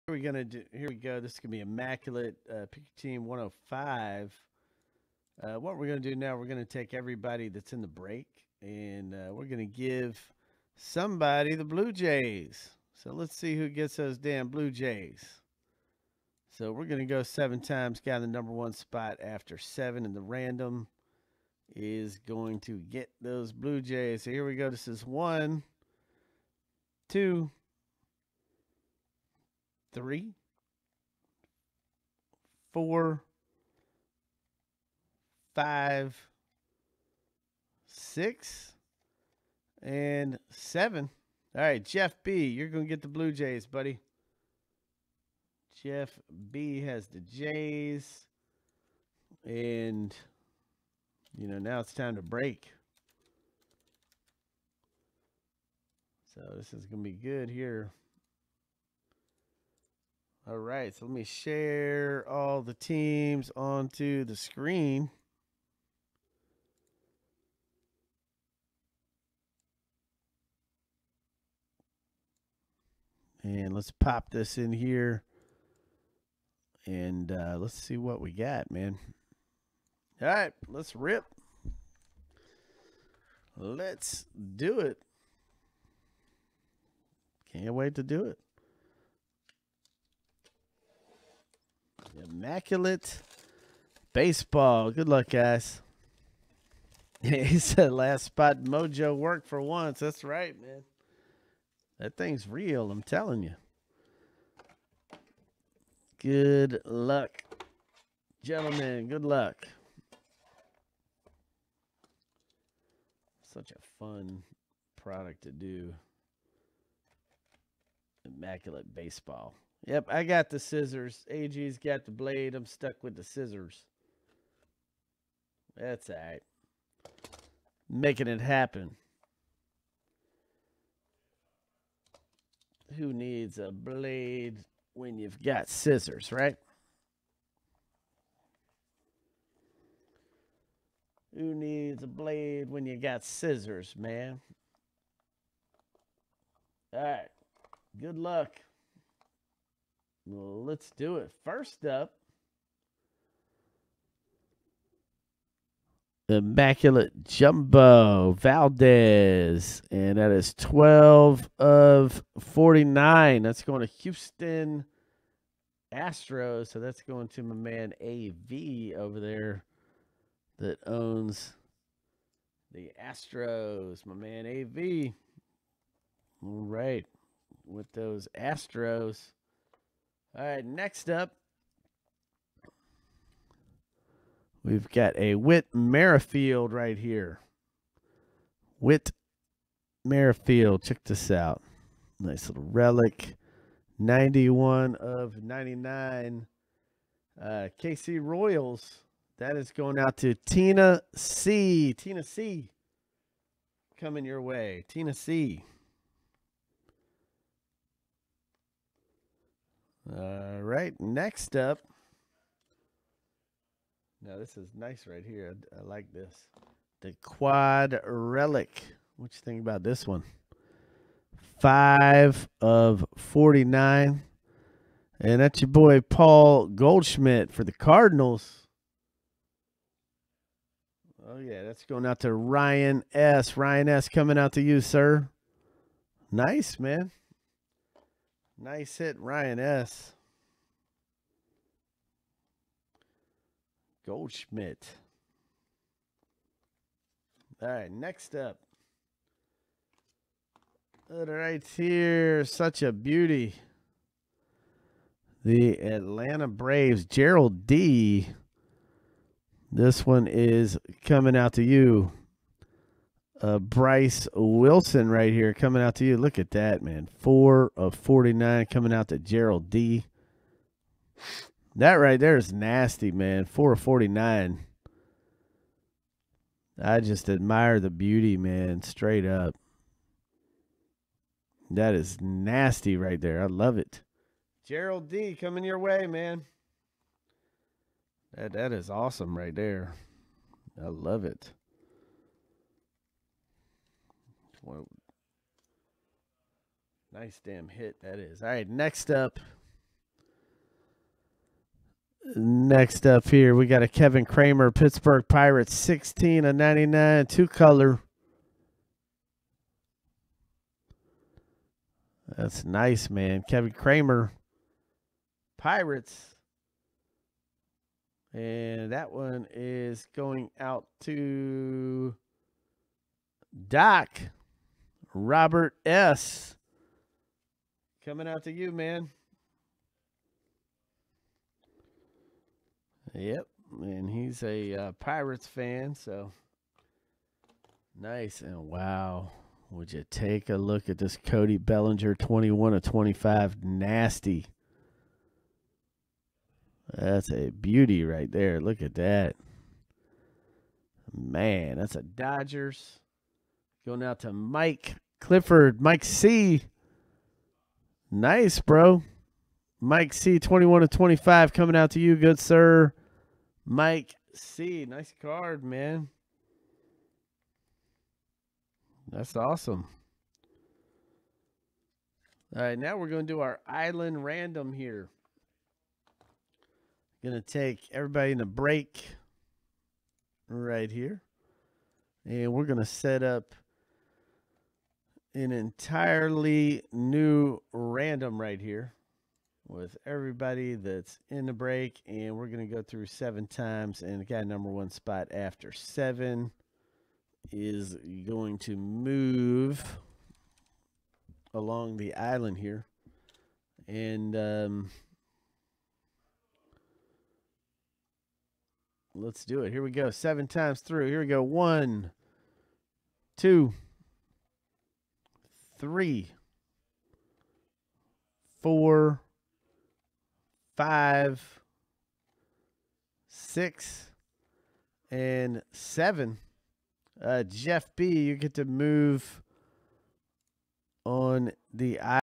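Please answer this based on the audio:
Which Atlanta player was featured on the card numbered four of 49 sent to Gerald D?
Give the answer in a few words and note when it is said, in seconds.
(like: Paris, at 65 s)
Bryse Wilson, at 263 s.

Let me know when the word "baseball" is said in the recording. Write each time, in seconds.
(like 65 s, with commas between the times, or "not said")
94 s, 118 s.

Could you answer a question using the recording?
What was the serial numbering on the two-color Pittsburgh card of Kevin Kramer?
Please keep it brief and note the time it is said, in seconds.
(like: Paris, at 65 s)
16 of 99, at 305 s.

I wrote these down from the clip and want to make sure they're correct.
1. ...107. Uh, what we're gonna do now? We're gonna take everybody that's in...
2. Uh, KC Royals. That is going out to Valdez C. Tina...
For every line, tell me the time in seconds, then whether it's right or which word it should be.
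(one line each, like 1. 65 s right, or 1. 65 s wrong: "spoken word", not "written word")
1. 3 s wrong: "105", not "107"
2. 197 s wrong: "Tina", not "Valdez".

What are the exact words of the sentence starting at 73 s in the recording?
And let's pop this in here.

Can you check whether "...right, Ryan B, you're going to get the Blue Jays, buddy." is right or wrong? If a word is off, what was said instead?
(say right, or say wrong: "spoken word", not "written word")
wrong: "Jeff", not "Ryan".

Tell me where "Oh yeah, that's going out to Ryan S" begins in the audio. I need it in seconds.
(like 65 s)
231 s.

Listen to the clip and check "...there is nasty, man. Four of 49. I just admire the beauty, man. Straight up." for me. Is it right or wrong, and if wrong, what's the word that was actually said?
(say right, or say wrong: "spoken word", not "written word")
right.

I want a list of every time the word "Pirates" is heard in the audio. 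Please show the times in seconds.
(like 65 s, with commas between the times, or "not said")
305 s, 315 s, 334 s.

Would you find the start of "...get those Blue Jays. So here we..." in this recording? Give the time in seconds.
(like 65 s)
22 s.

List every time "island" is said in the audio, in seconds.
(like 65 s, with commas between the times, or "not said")
373 s, 402 s.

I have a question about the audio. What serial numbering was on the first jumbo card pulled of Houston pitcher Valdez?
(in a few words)
12 of 49.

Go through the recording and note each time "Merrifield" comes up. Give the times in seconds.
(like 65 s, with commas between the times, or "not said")
185 s, 190 s.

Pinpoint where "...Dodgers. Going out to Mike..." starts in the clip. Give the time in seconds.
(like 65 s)
352 s.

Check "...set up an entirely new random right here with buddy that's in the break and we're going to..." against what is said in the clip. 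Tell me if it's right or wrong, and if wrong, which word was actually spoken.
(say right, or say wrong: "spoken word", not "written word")
wrong: "everybody", not "buddy".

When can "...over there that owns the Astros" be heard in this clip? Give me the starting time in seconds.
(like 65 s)
169 s.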